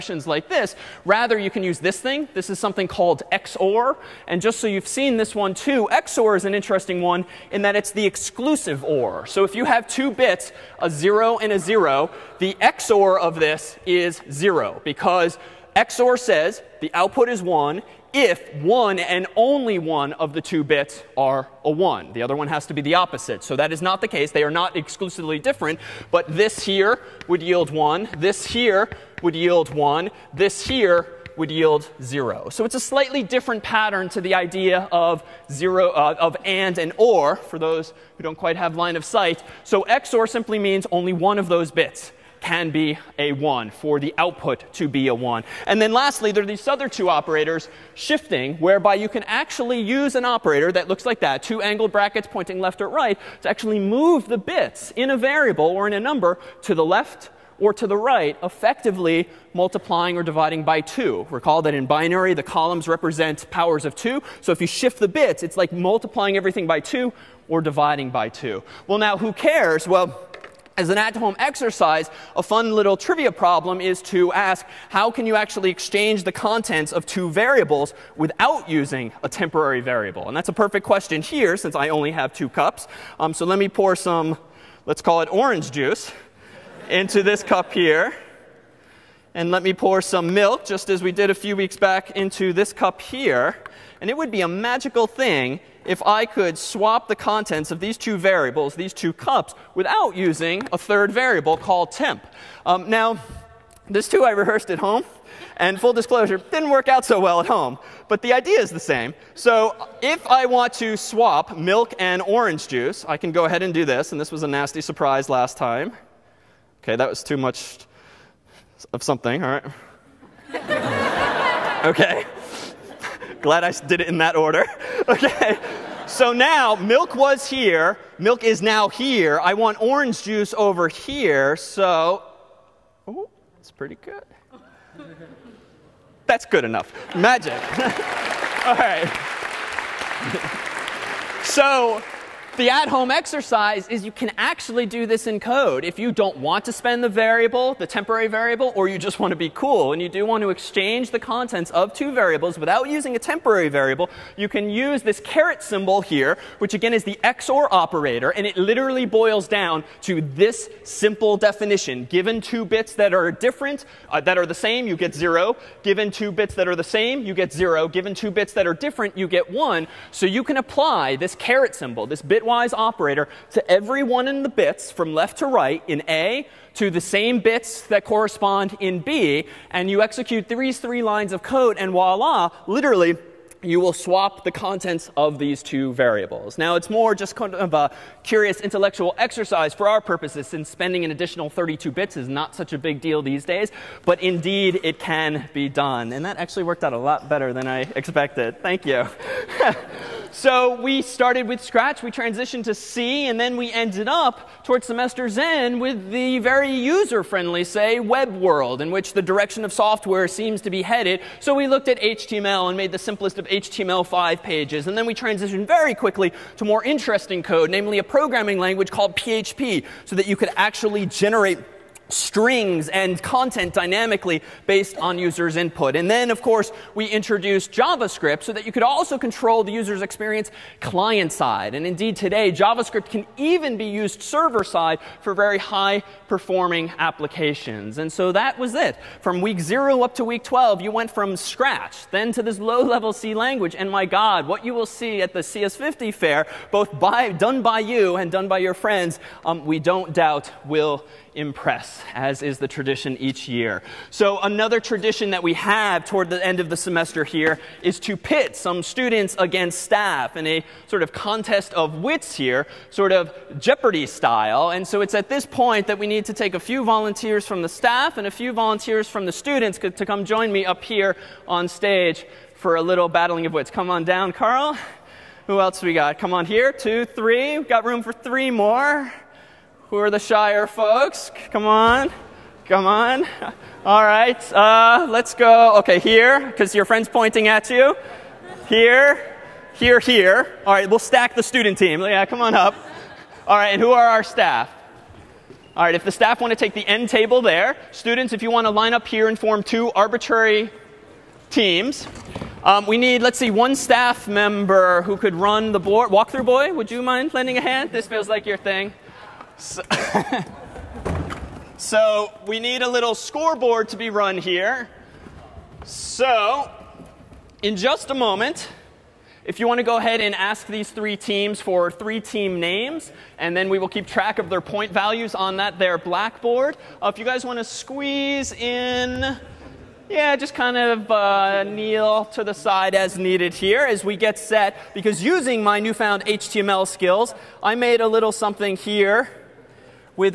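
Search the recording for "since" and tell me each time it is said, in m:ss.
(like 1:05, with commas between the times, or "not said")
1:21, 3:10.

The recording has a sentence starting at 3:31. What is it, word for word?
So we looked at HTML and made the simplest of HTML5 pages.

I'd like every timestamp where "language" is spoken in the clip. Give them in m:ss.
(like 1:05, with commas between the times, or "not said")
3:38, 4:03.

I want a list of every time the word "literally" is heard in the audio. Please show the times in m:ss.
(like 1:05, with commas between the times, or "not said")
2:38, 3:02.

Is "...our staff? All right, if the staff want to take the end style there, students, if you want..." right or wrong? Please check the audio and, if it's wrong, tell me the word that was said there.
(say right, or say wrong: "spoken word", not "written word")
wrong: "table", not "style".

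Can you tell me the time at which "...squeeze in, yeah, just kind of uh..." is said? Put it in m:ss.
5:27.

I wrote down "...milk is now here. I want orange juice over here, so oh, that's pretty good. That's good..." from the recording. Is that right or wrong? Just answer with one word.
right.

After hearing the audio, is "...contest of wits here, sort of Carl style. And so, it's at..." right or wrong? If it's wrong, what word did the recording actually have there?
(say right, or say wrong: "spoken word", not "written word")
wrong: "Jeopardy", not "Carl".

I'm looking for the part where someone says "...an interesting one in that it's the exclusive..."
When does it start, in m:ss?
0:06.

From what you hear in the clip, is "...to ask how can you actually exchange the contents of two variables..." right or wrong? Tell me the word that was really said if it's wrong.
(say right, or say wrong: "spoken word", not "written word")
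right.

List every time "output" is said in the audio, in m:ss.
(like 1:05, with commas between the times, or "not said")
0:16, 0:44.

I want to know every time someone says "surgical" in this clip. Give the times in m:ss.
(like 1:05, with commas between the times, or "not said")
not said.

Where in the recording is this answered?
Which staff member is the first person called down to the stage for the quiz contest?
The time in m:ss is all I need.
4:34.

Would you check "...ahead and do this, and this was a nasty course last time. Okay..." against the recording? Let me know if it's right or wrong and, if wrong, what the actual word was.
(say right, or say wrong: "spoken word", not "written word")
wrong: "surprise", not "course".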